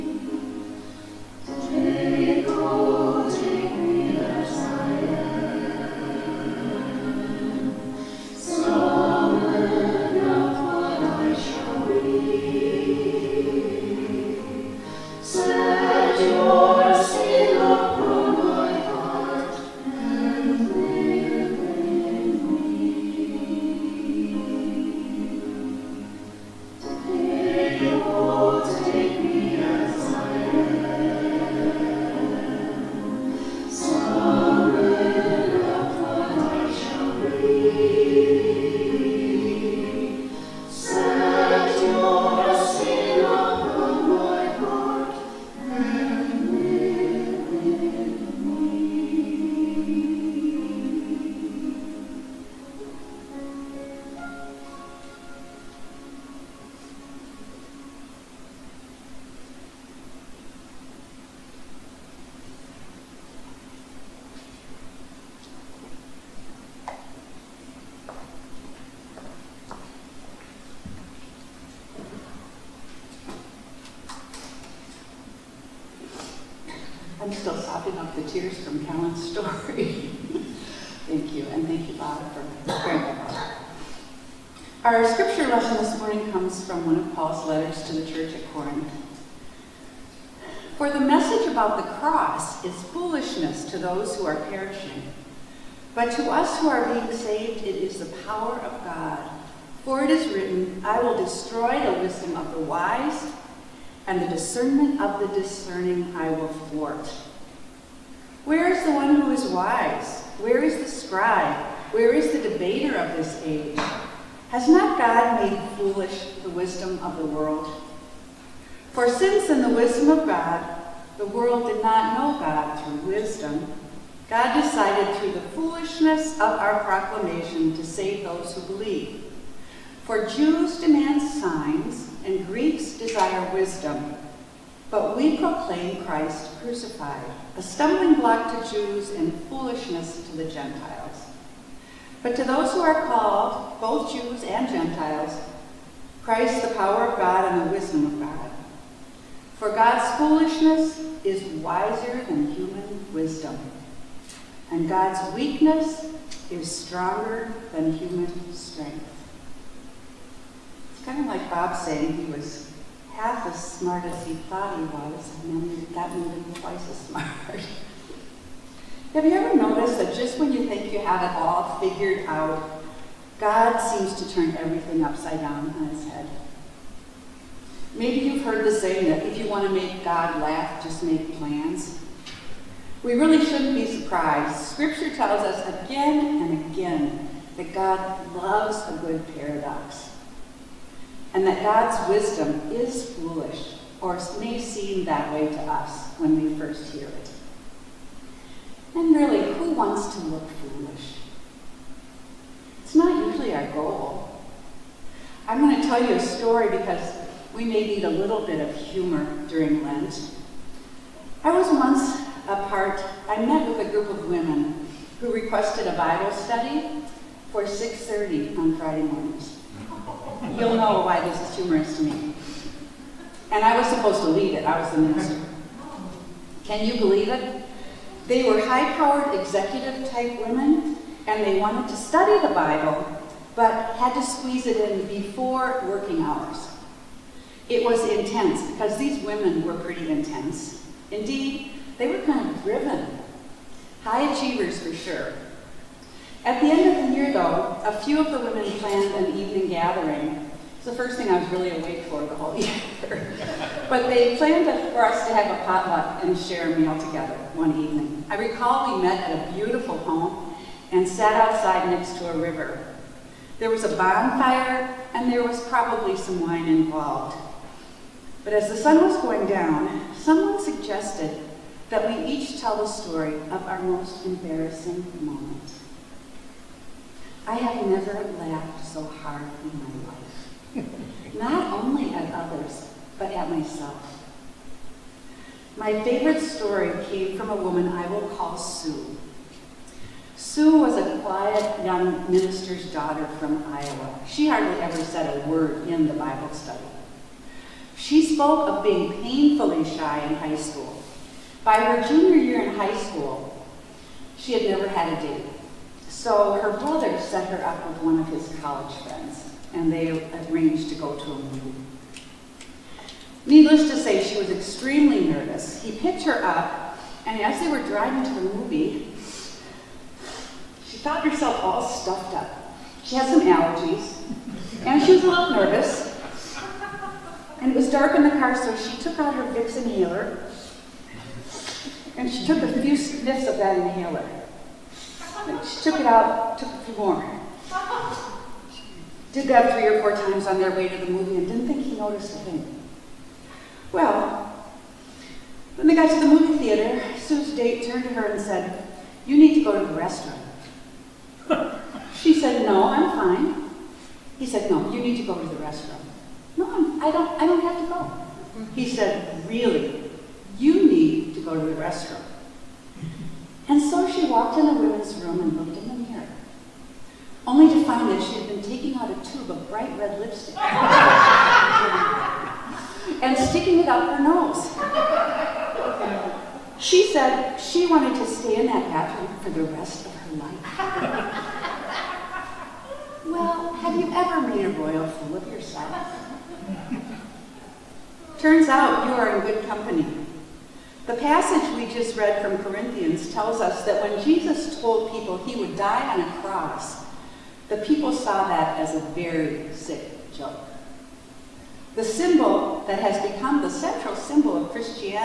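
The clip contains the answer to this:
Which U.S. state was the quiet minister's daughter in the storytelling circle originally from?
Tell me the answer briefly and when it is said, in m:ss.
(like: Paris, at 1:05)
Iowa, at 4:53.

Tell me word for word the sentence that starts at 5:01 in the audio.
By her junior year in high school, she had never had a date.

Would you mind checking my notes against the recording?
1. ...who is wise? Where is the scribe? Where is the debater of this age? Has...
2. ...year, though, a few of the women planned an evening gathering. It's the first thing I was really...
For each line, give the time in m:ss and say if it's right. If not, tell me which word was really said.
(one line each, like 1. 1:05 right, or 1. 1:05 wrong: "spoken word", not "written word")
1. 1:49 right
2. 4:07 right.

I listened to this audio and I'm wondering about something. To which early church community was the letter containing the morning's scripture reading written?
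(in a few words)
Corinth.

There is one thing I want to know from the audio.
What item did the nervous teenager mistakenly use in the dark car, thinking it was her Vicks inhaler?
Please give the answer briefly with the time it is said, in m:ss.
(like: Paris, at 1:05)
Bright red lipstick, at 6:09.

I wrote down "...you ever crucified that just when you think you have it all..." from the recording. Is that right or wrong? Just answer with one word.
wrong.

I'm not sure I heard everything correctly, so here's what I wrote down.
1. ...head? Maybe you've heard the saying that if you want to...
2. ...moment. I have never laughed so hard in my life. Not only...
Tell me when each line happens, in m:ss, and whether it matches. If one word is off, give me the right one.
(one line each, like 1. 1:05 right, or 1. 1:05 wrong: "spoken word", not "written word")
1. 2:56 right
2. 4:35 right.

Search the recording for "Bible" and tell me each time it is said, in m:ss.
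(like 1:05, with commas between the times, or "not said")
3:35, 3:52, 4:56.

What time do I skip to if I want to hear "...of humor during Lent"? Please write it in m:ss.
3:28.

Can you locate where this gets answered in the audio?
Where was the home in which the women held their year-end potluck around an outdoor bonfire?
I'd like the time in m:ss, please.
4:21.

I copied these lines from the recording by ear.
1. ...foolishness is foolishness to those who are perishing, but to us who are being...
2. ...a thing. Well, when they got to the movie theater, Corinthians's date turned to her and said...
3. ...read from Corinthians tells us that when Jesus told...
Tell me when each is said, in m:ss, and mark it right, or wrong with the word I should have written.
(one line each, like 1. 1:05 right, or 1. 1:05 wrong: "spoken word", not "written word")
1. 1:31 wrong: "cross", not "foolishness"
2. 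5:42 wrong: "Sue", not "Corinthians"
3. 6:32 right.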